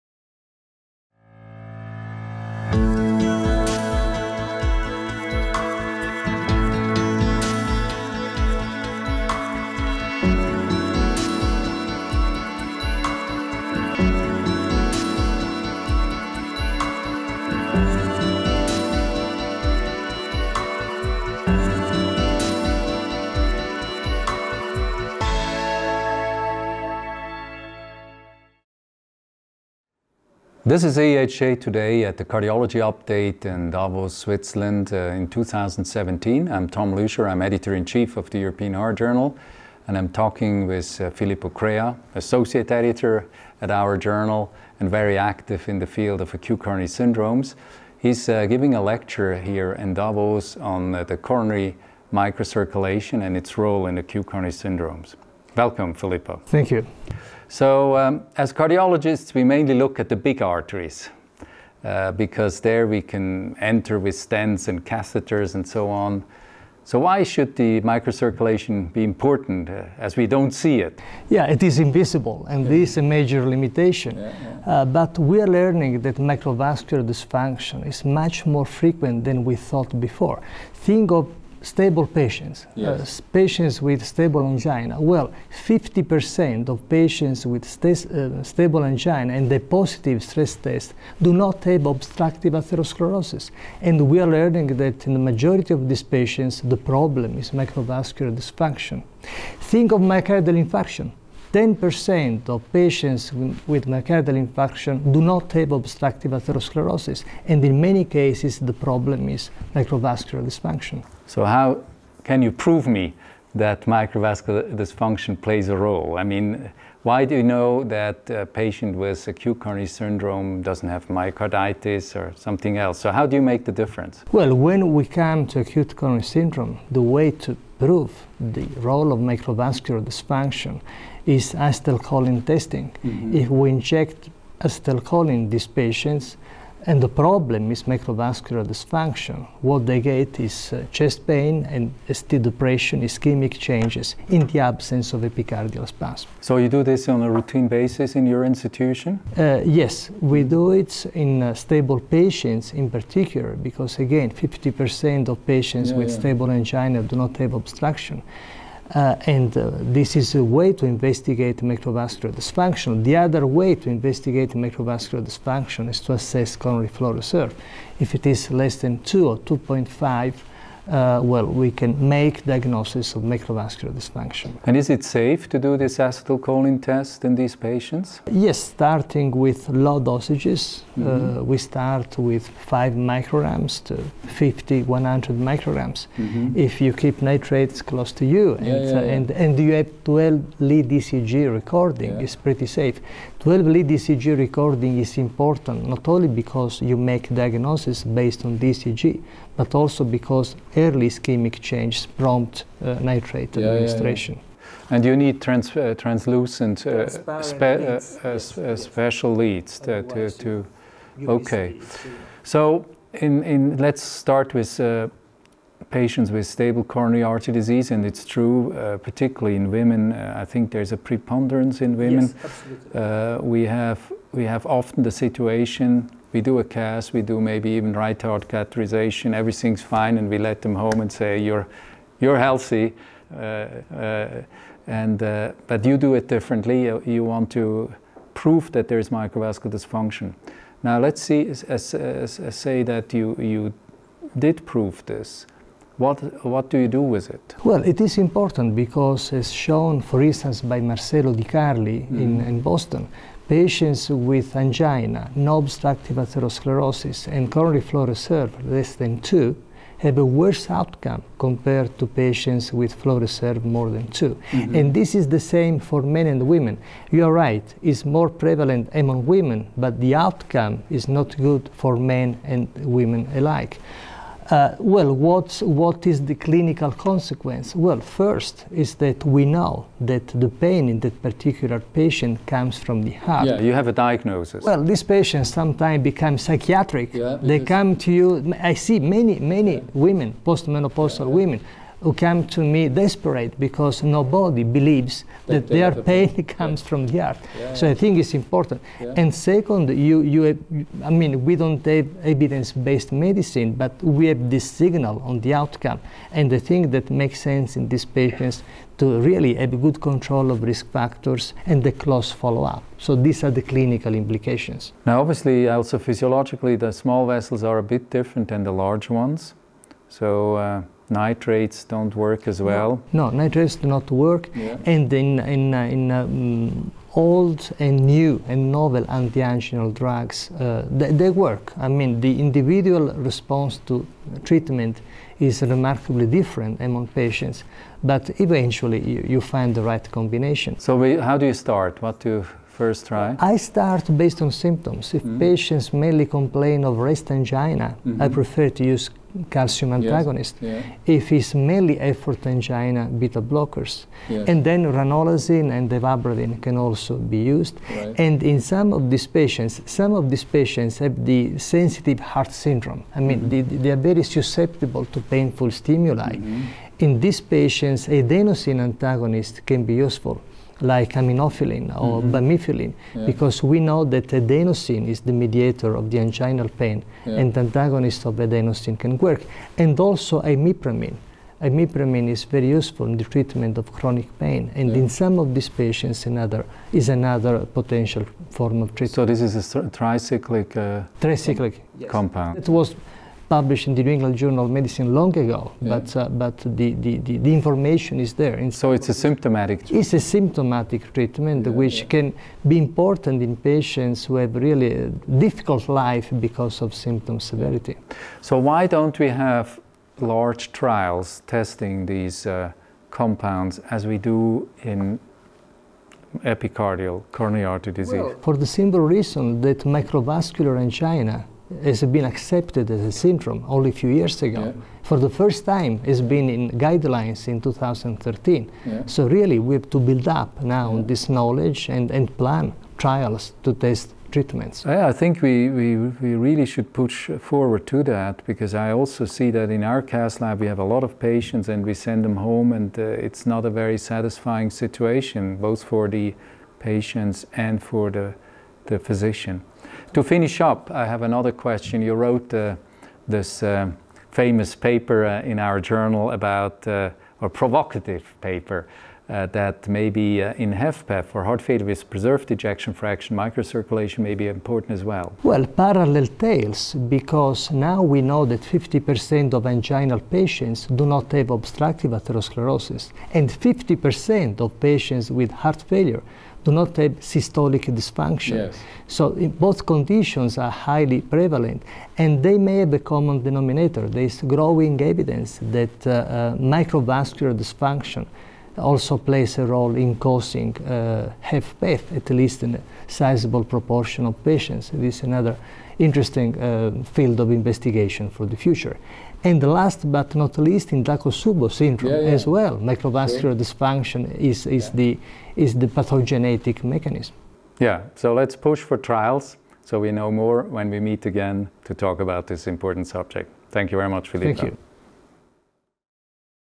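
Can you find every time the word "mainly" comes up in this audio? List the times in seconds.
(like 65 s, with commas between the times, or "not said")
59 s, 345 s, 351 s.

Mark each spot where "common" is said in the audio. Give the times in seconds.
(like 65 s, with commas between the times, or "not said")
482 s.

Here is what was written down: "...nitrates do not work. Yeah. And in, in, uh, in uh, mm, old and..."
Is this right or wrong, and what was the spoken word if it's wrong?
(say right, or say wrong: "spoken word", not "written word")
right.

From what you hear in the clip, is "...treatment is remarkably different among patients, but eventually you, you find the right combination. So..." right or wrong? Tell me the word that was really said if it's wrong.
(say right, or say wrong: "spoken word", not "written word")
right.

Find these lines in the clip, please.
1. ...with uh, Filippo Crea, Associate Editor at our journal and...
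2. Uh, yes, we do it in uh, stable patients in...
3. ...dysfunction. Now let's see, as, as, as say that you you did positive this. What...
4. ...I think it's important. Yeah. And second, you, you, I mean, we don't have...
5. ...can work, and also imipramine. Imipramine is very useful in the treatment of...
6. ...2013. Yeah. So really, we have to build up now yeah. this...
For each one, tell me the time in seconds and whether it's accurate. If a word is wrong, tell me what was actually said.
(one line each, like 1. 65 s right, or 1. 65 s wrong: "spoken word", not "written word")
1. 40 s right
2. 149 s right
3. 239 s wrong: "prove", not "positive"
4. 297 s right
5. 378 s right
6. 427 s right.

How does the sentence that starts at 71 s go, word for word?
Yeah, it is invisible and yeah.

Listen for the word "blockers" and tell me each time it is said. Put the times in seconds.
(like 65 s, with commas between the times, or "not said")
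353 s.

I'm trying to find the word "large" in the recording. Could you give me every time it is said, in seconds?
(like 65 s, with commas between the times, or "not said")
318 s, 410 s.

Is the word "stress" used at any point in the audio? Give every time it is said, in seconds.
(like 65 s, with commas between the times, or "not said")
90 s.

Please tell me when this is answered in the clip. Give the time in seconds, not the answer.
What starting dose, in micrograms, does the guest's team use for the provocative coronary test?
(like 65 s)
182 s.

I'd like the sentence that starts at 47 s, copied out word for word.
He's uh, giving a lecture here in Davos on uh, the coronary microcirculation and its role in acute coronary syndromes.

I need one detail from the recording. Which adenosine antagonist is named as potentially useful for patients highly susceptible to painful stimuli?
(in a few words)
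aminophylline.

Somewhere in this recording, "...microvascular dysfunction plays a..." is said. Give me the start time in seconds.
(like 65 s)
113 s.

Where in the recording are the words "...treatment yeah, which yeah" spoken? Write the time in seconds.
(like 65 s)
401 s.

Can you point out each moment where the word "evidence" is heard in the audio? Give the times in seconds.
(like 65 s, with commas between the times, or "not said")
302 s, 485 s.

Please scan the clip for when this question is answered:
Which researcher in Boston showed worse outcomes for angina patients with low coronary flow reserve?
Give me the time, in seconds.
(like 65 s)
250 s.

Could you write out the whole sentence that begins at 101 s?
10% of patients with myocardial infarction do not have obstructive atherosclerosis, and in many cases, the problem is microvascular dysfunction.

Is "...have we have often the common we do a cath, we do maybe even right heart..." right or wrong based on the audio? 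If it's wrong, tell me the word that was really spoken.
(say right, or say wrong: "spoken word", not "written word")
wrong: "situation", not "common".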